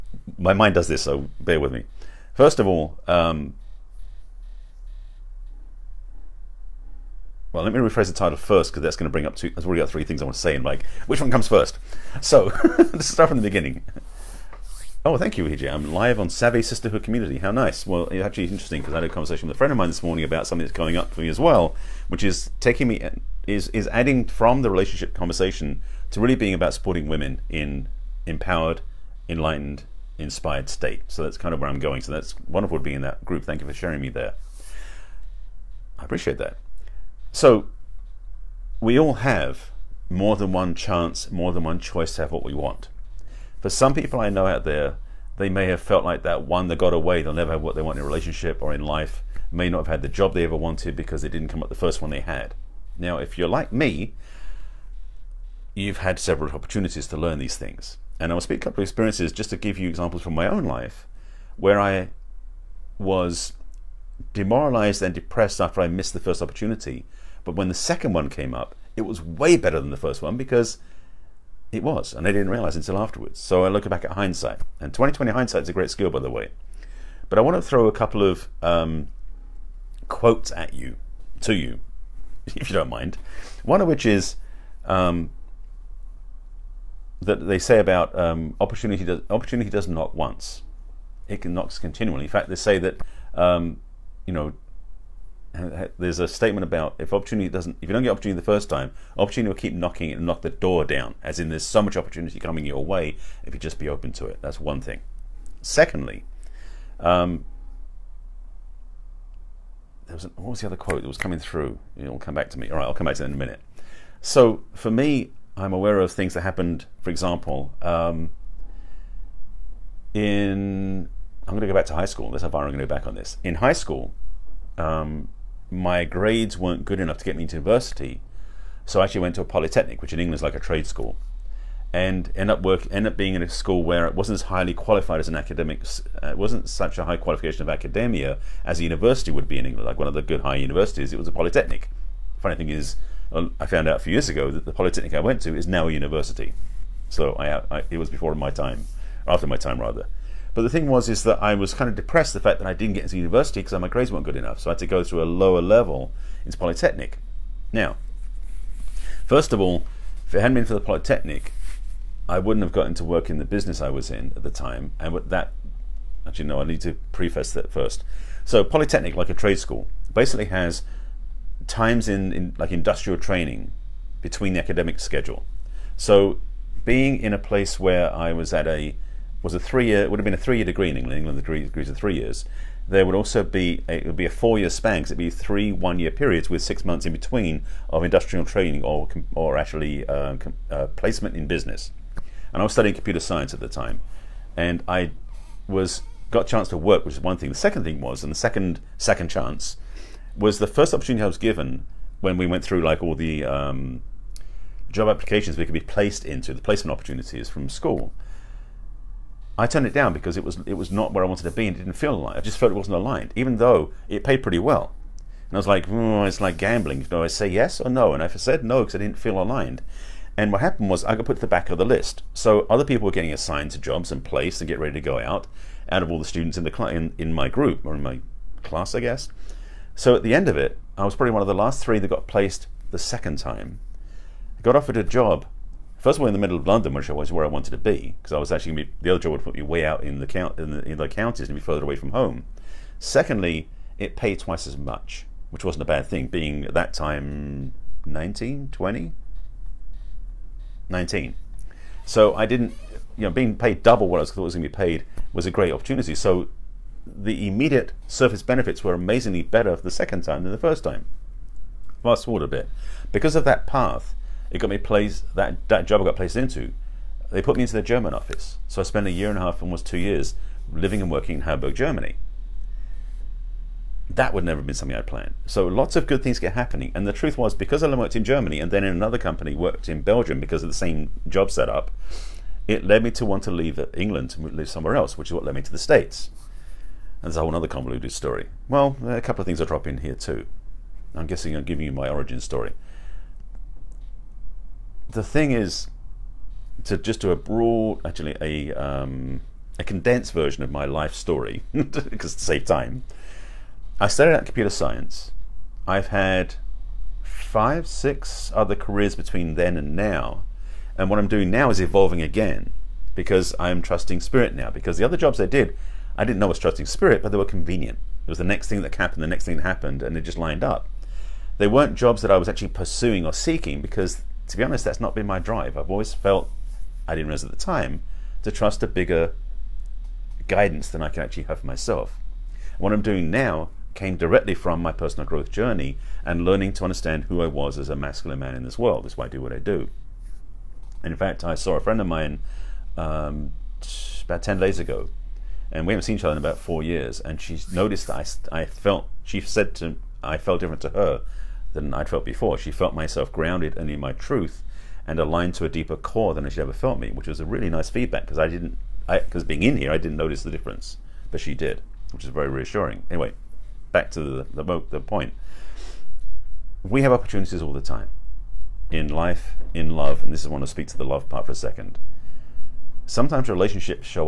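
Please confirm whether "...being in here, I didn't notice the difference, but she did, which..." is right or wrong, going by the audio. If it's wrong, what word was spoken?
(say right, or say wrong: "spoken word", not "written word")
right.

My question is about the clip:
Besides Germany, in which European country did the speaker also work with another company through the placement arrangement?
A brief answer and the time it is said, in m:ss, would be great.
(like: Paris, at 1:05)
Belgium, at 4:40.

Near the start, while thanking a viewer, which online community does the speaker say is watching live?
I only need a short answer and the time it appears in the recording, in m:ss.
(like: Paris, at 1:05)
Savvy Sisterhood Community, at 0:16.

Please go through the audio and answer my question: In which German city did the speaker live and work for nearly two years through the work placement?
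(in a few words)
Hamburg.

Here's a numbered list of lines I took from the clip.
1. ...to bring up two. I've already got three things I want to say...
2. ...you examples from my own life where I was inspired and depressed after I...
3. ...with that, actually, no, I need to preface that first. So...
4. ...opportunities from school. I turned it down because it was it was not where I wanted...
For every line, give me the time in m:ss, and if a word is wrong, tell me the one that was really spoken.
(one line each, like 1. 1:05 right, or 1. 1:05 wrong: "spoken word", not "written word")
1. 0:09 right
2. 0:59 wrong: "demoralized", not "inspired"
3. 2:45 right
4. 3:26 right.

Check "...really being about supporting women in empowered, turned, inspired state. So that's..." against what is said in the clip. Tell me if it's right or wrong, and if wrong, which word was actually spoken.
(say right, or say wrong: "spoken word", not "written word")
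wrong: "enlightened", not "turned".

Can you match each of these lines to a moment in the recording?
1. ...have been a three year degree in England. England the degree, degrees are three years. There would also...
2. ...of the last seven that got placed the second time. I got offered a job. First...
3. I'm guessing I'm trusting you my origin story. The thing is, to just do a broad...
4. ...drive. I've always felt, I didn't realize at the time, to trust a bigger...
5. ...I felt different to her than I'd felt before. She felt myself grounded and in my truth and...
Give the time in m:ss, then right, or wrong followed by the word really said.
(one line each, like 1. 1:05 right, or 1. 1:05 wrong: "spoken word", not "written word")
1. 3:00 right
2. 3:51 wrong: "three", not "seven"
3. 4:51 wrong: "giving", not "trusting"
4. 5:25 right
5. 5:50 right.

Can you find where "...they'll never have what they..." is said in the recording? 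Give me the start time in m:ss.
0:47.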